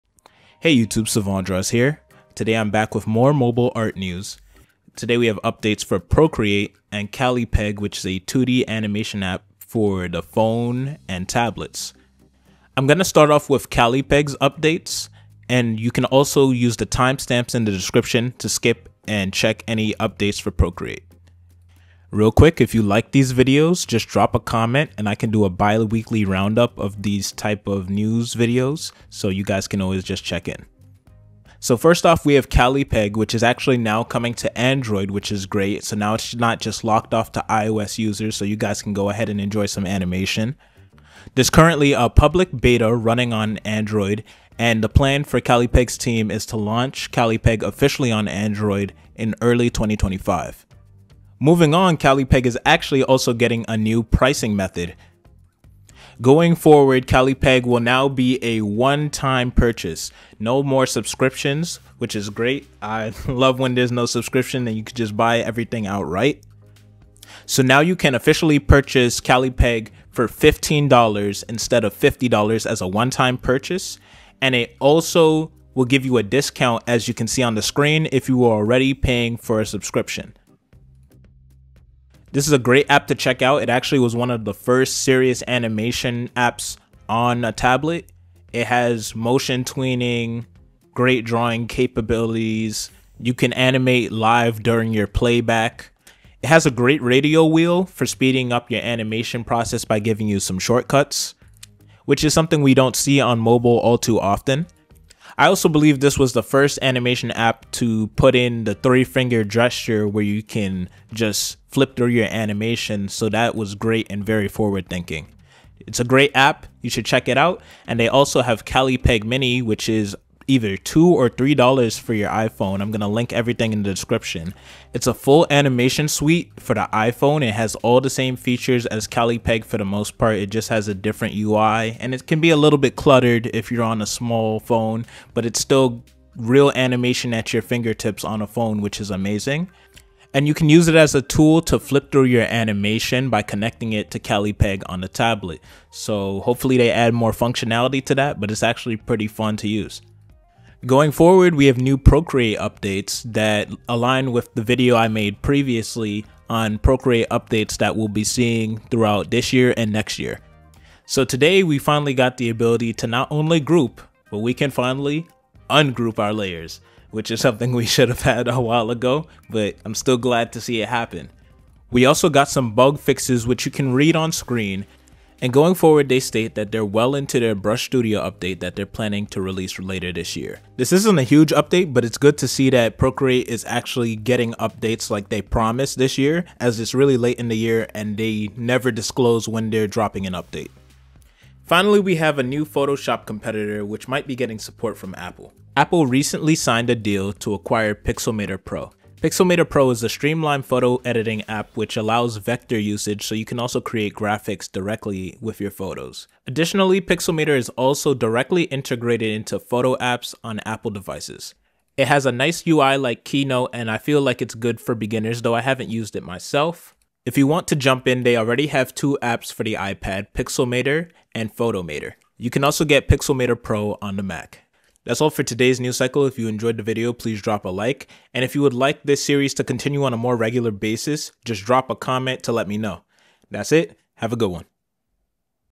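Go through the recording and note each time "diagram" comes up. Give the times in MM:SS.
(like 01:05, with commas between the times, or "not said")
not said.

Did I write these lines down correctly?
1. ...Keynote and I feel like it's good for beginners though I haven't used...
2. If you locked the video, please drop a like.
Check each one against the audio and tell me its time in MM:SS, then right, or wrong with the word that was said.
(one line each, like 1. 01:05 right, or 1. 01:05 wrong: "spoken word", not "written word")
1. 03:33 right
2. 03:46 wrong: "enjoyed", not "locked".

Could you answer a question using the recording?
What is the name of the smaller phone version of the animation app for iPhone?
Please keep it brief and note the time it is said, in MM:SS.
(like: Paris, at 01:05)
Callipeg Mini, at 01:58.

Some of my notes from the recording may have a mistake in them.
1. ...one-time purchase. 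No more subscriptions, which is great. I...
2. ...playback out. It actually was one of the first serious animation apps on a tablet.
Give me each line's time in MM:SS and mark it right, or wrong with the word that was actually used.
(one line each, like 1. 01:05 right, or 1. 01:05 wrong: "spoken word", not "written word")
1. 00:58 right
2. 01:23 wrong: "check", not "playback".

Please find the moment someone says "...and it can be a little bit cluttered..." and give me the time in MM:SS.
02:12.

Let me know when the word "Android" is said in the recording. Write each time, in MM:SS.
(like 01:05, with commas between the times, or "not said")
00:34, 00:43, 00:48.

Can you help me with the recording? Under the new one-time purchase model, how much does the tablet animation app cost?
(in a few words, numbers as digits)
$15.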